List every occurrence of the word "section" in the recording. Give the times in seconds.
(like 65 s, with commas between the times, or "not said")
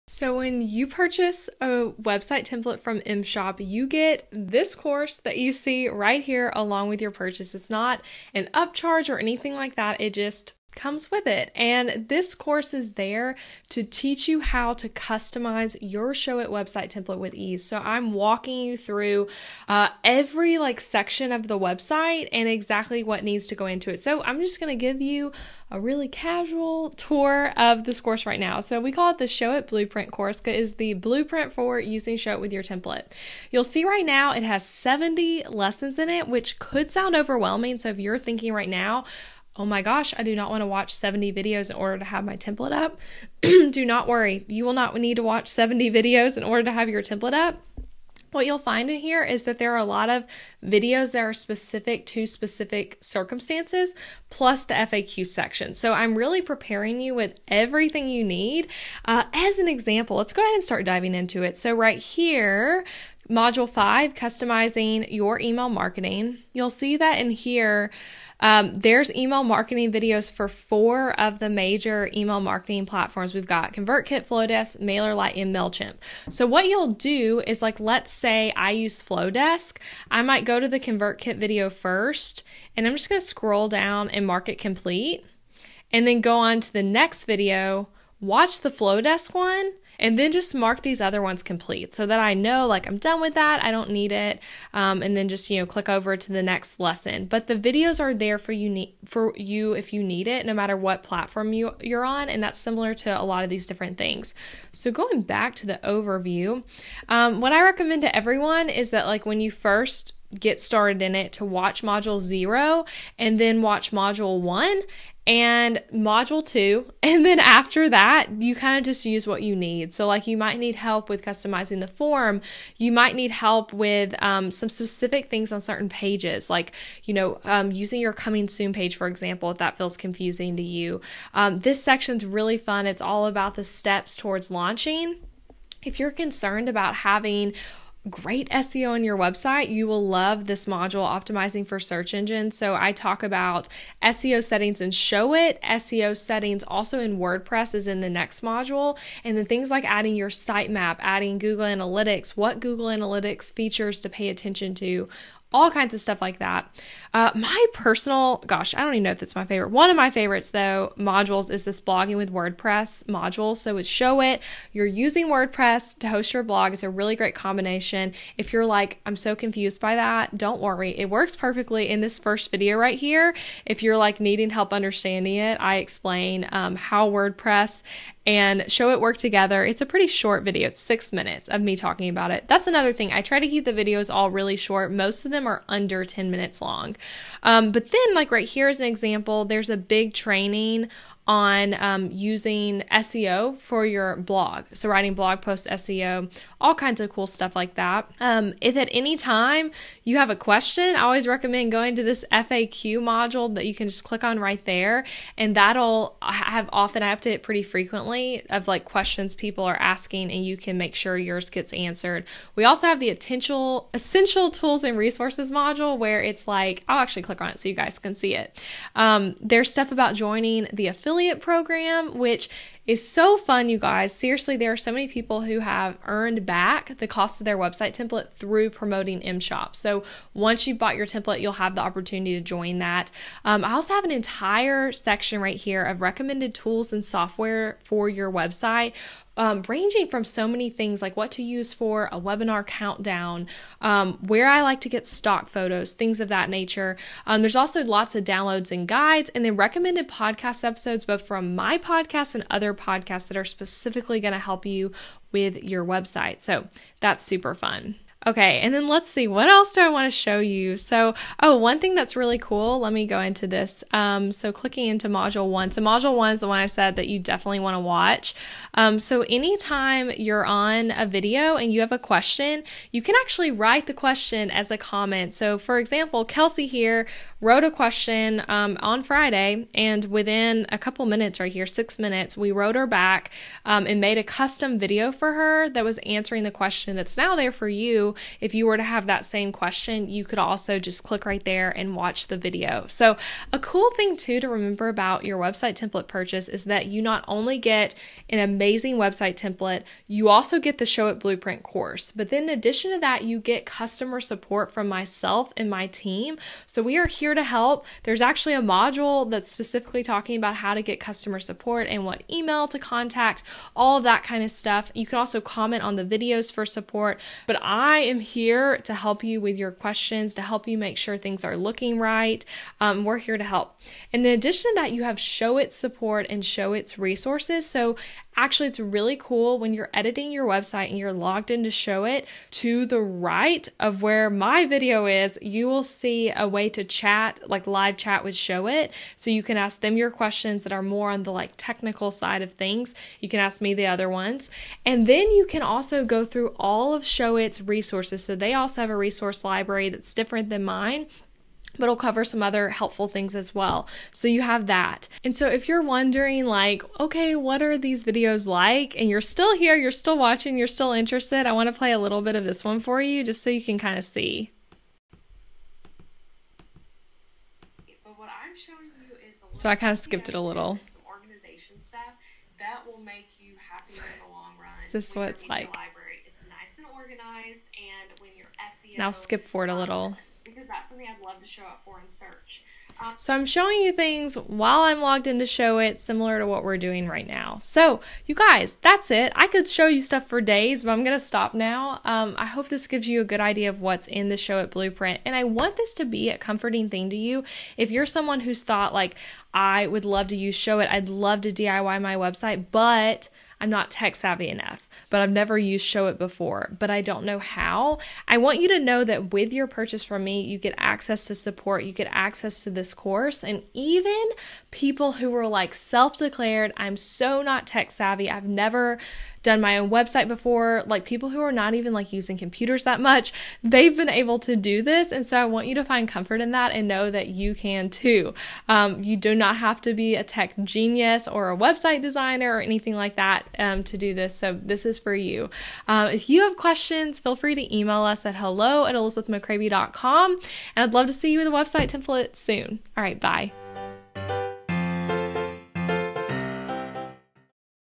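20 s, 55 s, 131 s, 234 s.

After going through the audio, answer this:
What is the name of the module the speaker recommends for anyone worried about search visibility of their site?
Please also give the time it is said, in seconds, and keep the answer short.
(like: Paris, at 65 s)
Optimizing for Search Engine, at 141 s.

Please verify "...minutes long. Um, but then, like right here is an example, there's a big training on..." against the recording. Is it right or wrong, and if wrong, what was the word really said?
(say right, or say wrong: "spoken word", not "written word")
right.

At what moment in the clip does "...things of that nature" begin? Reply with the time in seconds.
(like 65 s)
245 s.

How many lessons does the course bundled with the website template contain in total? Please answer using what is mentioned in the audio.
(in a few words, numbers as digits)
70.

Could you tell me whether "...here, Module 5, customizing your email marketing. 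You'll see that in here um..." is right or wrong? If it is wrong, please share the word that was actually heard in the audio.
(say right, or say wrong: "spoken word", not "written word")
right.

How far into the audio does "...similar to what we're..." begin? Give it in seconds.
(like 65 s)
385 s.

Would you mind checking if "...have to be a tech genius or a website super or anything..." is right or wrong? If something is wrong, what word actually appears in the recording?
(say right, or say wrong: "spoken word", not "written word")
wrong: "designer", not "super".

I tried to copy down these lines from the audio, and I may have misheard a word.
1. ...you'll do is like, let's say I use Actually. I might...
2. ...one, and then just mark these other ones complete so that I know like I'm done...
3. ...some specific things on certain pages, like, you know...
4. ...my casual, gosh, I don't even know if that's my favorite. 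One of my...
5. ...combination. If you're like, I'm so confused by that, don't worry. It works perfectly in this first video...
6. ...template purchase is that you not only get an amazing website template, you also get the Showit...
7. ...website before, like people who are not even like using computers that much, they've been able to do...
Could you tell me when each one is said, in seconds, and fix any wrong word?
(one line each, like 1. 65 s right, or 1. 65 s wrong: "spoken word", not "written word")
1. 76 s wrong: "Flodesk", not "Actually"
2. 89 s right
3. 124 s right
4. 157 s wrong: "personal", not "casual"
5. 167 s right
6. 295 s right
7. 419 s right.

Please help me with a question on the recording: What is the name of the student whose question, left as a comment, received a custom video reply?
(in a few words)
Kelsey.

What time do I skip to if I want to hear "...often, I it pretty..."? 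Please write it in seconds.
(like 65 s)
206 s.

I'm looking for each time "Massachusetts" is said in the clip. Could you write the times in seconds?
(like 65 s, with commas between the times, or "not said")
not said.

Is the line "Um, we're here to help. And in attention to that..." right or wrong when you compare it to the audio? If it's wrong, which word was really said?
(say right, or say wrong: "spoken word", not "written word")
wrong: "addition", not "attention".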